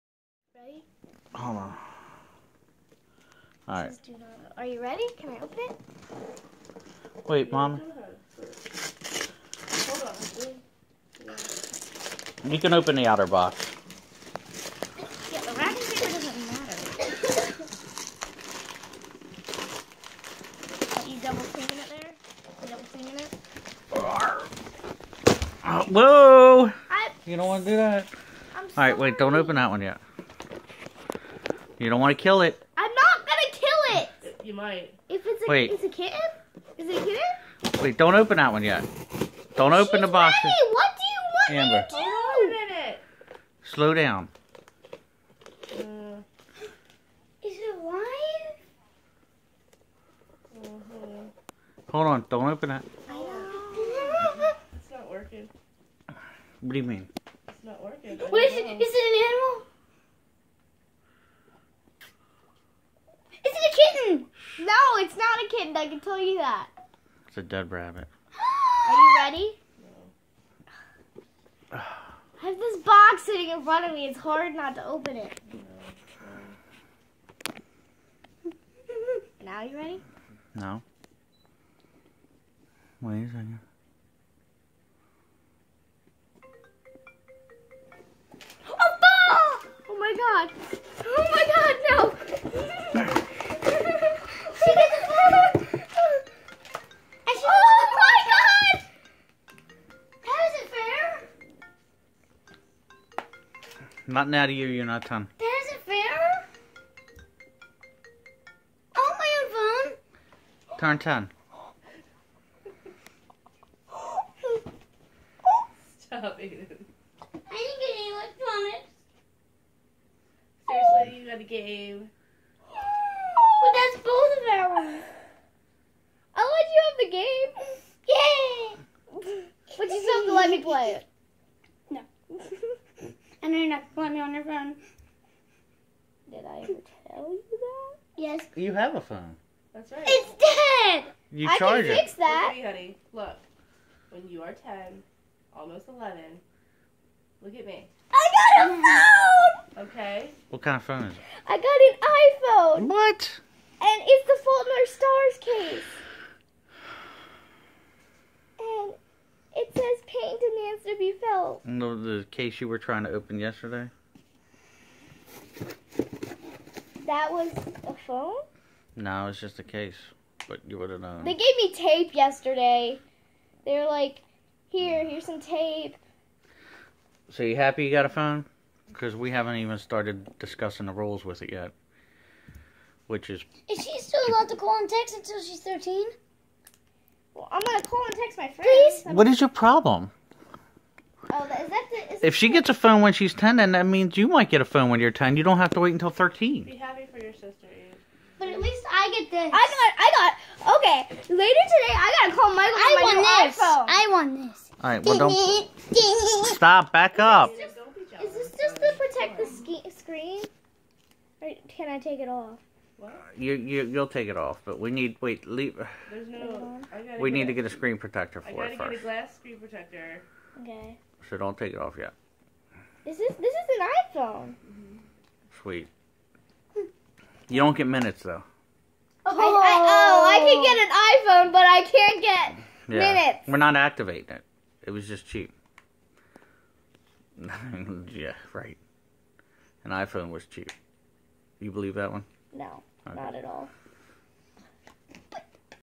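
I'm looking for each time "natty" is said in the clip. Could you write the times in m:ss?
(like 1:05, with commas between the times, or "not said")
1:44.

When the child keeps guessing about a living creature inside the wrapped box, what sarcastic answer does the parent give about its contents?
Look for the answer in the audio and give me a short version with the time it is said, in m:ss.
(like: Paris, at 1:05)
A dead rabbit, at 1:07.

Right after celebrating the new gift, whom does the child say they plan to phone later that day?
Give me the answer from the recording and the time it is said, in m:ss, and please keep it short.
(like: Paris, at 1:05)
Michael, at 3:22.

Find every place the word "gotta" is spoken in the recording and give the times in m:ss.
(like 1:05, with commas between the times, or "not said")
3:22, 3:38.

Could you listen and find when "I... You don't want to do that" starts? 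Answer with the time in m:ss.
0:26.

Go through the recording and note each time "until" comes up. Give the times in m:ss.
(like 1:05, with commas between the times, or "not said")
3:05, 3:15.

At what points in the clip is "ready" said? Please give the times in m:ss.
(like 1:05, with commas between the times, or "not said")
0:00, 0:04, 0:40, 1:09, 1:19.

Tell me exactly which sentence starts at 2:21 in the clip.
You I charge can fix that.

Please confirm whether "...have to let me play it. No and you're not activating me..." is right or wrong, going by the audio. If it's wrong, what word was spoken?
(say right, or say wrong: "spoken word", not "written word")
wrong: "calling", not "activating".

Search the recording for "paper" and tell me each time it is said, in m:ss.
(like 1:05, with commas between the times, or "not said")
0:15.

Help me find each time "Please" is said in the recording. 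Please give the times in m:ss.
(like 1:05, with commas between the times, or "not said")
3:09.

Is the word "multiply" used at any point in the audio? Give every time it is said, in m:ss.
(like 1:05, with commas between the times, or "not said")
not said.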